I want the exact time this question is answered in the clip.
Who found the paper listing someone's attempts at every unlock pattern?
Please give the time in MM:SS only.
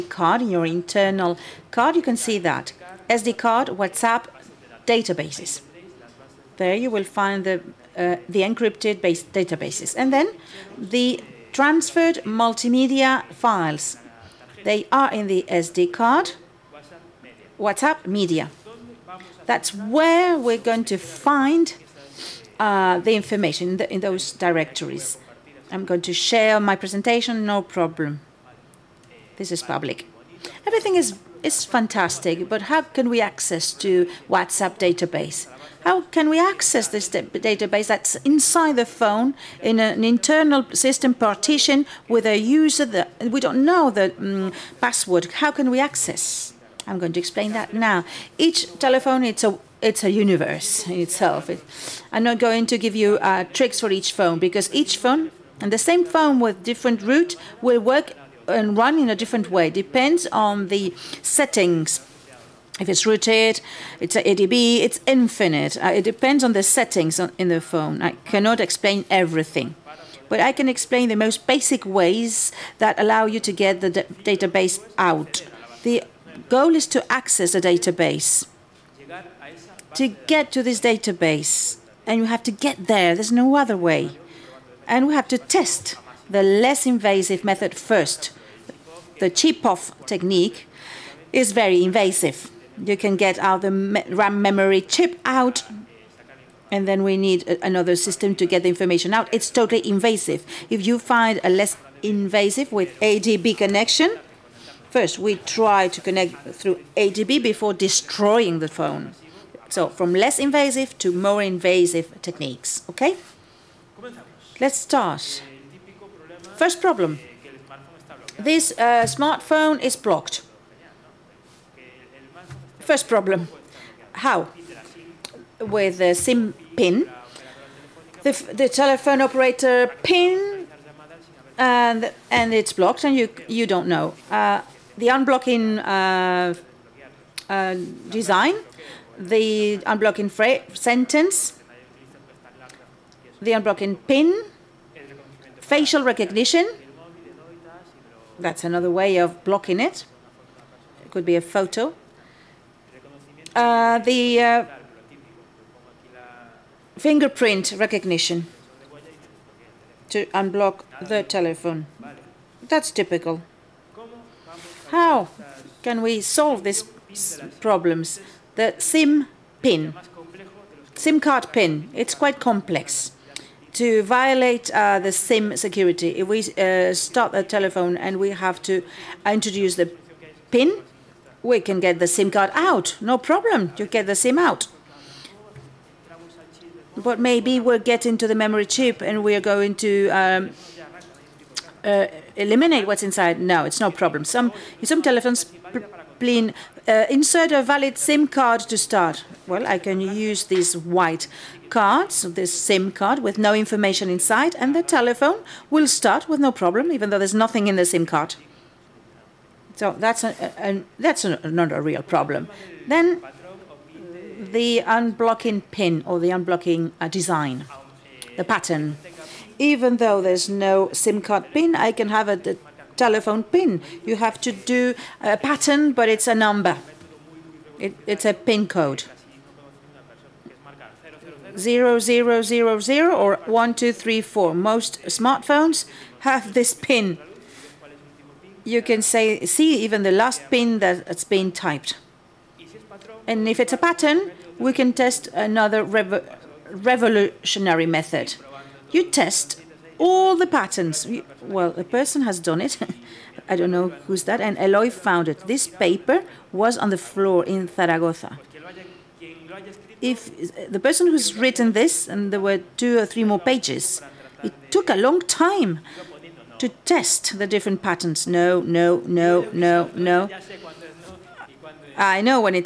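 04:14.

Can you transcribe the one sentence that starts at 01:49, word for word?
So from less invasive to more invasive techniques, okay?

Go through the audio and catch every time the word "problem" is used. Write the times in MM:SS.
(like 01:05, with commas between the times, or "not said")
00:27, 01:56, 02:03, 02:47, 03:03, 03:13, 03:26, 03:32.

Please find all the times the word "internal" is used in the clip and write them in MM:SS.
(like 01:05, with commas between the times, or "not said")
00:00, 00:40.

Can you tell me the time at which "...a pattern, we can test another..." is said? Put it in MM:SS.
04:03.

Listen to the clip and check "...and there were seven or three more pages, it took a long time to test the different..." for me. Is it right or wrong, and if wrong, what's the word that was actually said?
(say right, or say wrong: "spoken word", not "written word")
wrong: "two", not "seven".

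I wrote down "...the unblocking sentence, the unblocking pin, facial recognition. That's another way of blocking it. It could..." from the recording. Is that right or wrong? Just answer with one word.
right.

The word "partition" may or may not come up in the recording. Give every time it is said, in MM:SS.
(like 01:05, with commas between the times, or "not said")
00:41.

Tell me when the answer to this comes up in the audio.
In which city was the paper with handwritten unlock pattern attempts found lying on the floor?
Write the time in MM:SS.
04:17.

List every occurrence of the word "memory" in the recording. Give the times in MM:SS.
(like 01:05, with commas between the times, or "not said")
01:34, 03:08.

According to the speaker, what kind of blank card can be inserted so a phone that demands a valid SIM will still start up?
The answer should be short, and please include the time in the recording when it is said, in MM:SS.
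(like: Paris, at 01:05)
White cards, at 03:20.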